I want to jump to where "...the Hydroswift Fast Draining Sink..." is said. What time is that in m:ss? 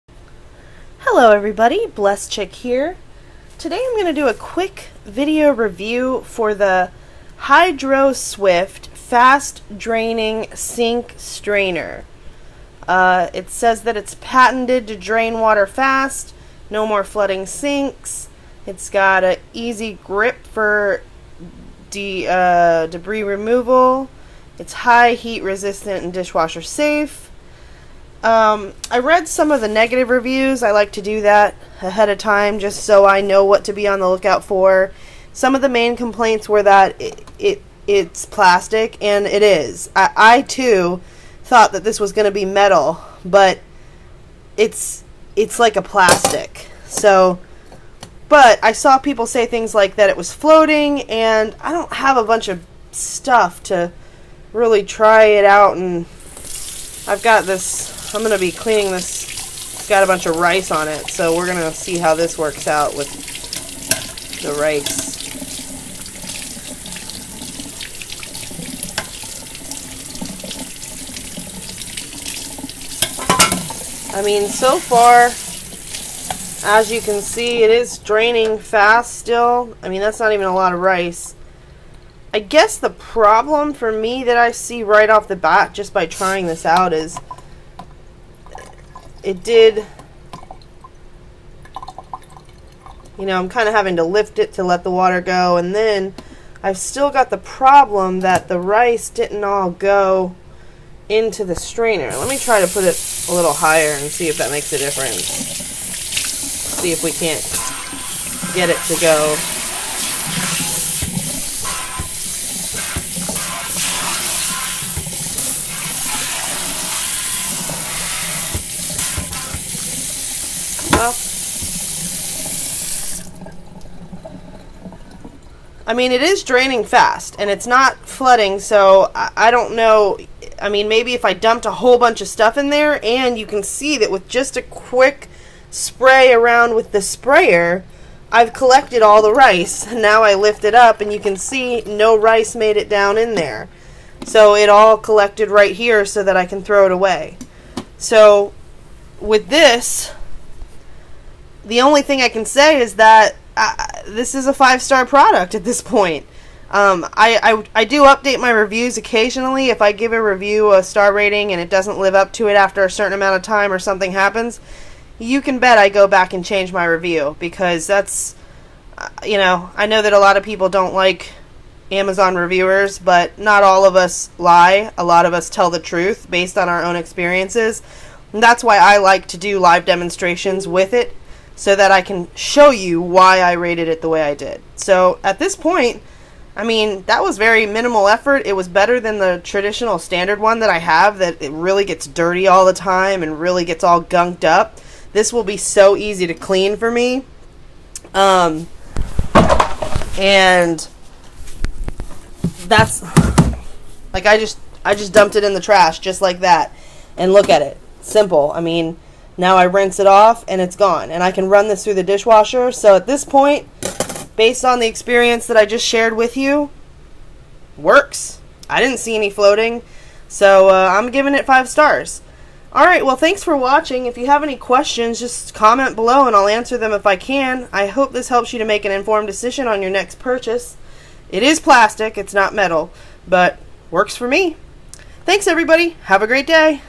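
0:06.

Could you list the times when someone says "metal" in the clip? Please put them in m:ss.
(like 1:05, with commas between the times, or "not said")
0:42, 3:52.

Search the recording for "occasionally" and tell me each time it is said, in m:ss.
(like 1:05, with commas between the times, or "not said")
2:38.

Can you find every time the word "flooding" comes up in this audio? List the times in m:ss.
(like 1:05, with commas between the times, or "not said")
0:17, 2:08.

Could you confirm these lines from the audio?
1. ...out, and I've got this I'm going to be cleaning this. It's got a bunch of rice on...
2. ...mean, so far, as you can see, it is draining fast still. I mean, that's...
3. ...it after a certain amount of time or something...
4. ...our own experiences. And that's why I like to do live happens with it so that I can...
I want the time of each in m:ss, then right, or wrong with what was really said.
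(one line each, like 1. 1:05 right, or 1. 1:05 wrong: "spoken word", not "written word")
1. 0:55 right
2. 1:14 right
3. 2:42 right
4. 2:56 wrong: "demonstrations", not "happens".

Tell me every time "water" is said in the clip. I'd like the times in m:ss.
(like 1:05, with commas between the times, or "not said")
0:15, 1:34.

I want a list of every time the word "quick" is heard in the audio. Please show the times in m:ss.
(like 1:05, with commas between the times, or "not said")
0:04, 2:14.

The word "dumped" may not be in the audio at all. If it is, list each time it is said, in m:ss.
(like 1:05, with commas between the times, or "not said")
2:11, 3:25.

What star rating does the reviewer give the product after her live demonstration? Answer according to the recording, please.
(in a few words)
5 stars.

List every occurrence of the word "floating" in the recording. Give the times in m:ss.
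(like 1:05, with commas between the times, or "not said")
0:50, 3:39.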